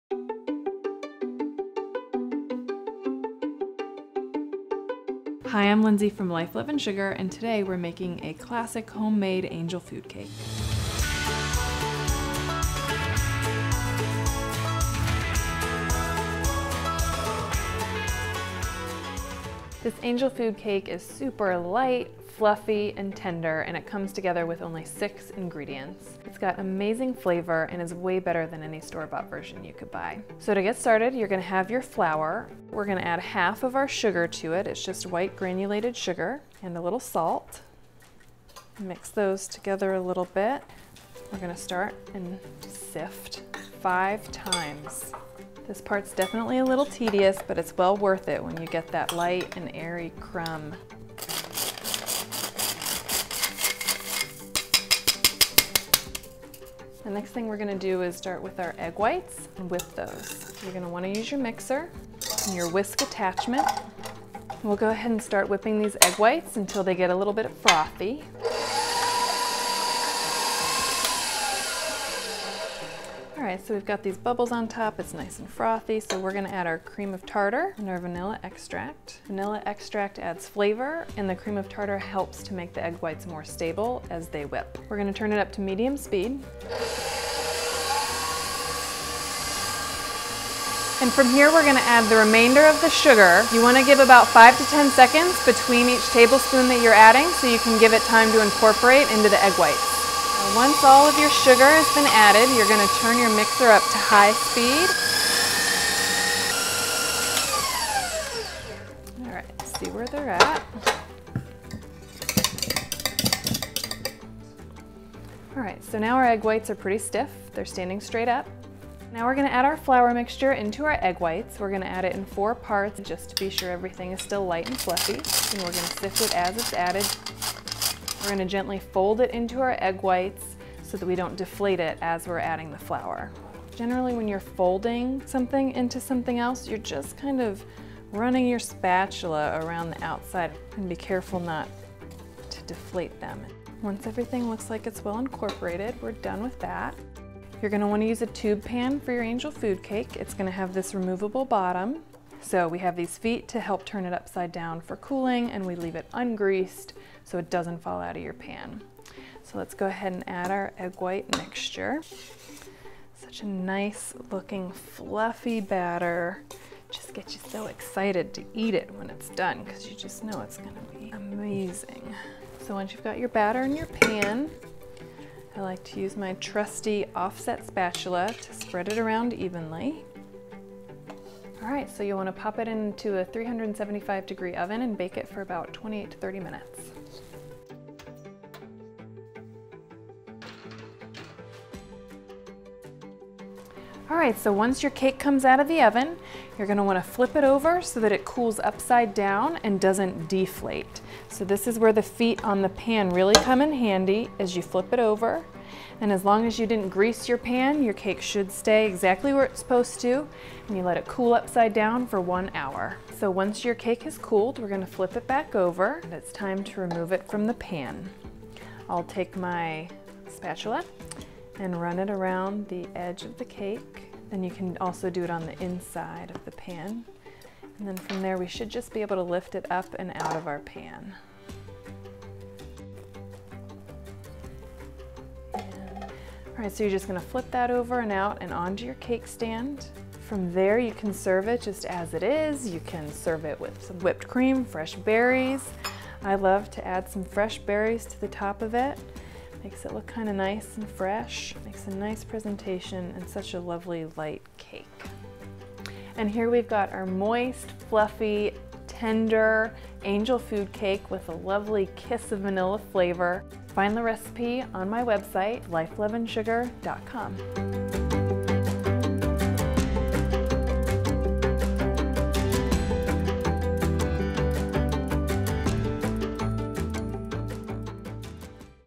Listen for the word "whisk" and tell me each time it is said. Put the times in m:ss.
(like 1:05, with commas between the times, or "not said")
1:02.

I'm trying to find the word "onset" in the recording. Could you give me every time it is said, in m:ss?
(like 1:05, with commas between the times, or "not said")
not said.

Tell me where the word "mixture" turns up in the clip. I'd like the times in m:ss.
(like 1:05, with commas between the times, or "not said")
2:00, 2:41.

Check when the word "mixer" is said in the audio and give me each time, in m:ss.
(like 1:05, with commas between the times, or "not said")
1:01, 1:43.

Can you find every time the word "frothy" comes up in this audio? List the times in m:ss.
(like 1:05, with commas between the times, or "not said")
1:07, 1:15.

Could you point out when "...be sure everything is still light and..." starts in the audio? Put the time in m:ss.
2:03.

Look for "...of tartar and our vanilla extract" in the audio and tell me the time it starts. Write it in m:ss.
1:17.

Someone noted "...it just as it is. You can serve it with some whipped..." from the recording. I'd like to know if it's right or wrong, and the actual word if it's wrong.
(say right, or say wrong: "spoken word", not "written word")
right.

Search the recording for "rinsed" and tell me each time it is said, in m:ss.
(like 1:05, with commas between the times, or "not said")
not said.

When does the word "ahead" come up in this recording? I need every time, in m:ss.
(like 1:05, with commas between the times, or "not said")
1:04, 2:39.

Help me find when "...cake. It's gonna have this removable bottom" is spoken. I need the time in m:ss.
2:29.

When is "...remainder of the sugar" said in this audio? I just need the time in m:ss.
1:32.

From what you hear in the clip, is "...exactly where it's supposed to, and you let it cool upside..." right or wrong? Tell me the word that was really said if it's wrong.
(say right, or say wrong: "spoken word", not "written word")
right.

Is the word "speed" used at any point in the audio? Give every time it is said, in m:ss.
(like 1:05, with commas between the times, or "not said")
1:25, 1:44.